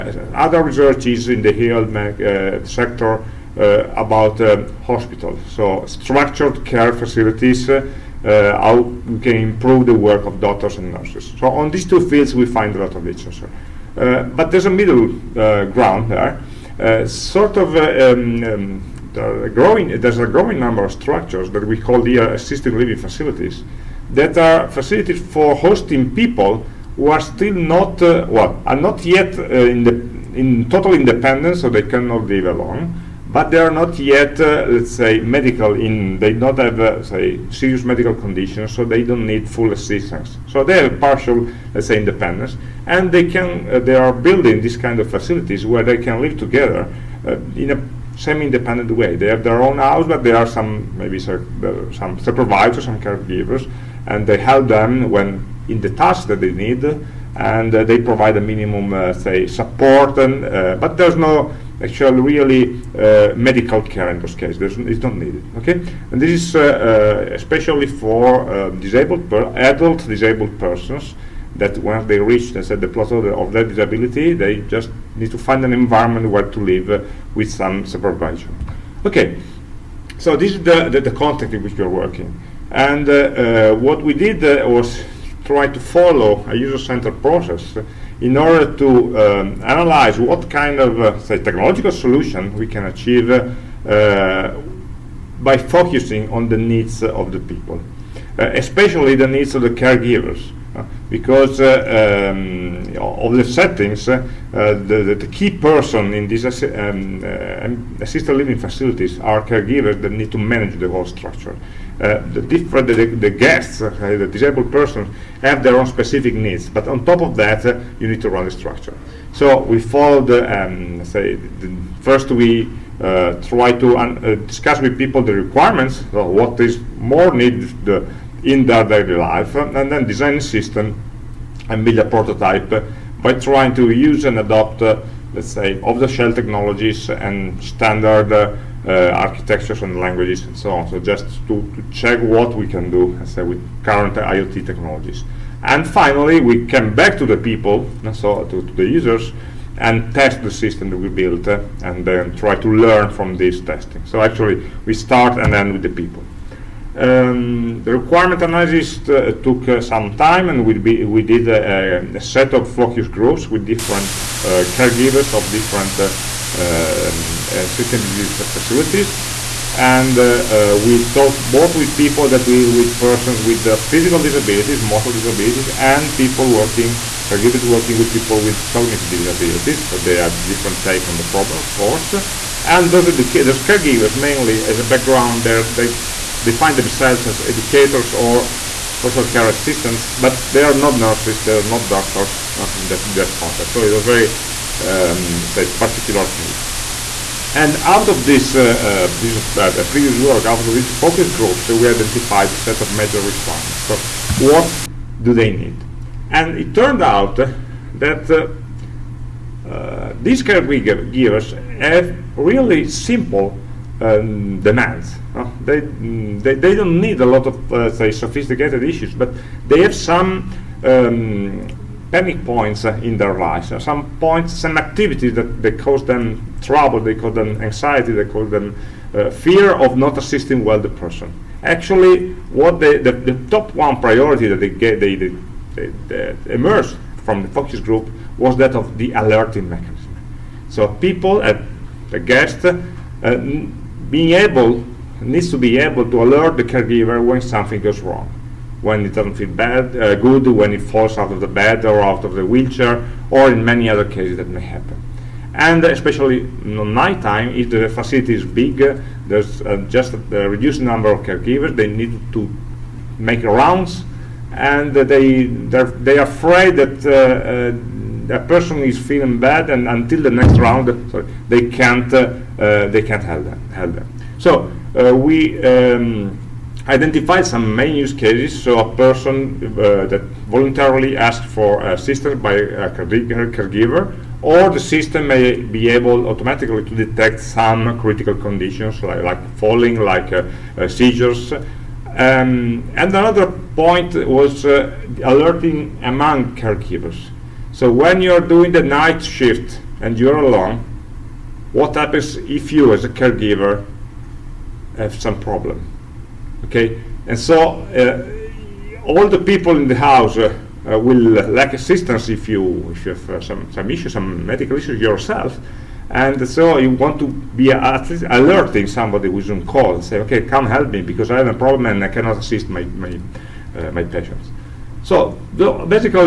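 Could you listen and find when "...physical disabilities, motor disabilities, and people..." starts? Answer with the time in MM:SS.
02:53.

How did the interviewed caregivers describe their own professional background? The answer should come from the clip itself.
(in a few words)
educators or social care assistants.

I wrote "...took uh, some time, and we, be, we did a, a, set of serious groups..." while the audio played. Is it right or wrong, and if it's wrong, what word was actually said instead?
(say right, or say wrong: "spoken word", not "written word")
wrong: "focus", not "serious".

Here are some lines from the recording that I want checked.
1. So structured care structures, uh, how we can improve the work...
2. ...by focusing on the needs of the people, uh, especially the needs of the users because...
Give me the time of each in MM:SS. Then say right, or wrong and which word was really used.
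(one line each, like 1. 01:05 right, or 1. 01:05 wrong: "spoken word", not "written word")
1. 00:05 wrong: "facilities", not "structures"
2. 01:35 wrong: "caregivers", not "users".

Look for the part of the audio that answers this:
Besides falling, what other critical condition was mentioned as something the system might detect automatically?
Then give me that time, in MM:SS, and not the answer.
04:50.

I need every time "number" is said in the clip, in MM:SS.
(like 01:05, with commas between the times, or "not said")
00:20, 04:20.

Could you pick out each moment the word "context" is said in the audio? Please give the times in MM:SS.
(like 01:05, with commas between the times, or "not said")
01:21, 03:13.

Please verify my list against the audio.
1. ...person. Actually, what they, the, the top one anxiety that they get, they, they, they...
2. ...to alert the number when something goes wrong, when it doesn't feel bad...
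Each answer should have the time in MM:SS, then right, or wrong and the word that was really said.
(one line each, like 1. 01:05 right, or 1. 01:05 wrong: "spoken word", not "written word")
1. 03:50 wrong: "priority", not "anxiety"
2. 04:06 wrong: "caregiver", not "number".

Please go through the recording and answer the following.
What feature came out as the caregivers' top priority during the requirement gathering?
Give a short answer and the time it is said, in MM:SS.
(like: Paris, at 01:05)
alerting mechanism, at 03:59.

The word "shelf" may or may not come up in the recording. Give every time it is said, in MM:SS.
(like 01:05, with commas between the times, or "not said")
02:15.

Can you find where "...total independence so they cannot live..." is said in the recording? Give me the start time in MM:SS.
00:30.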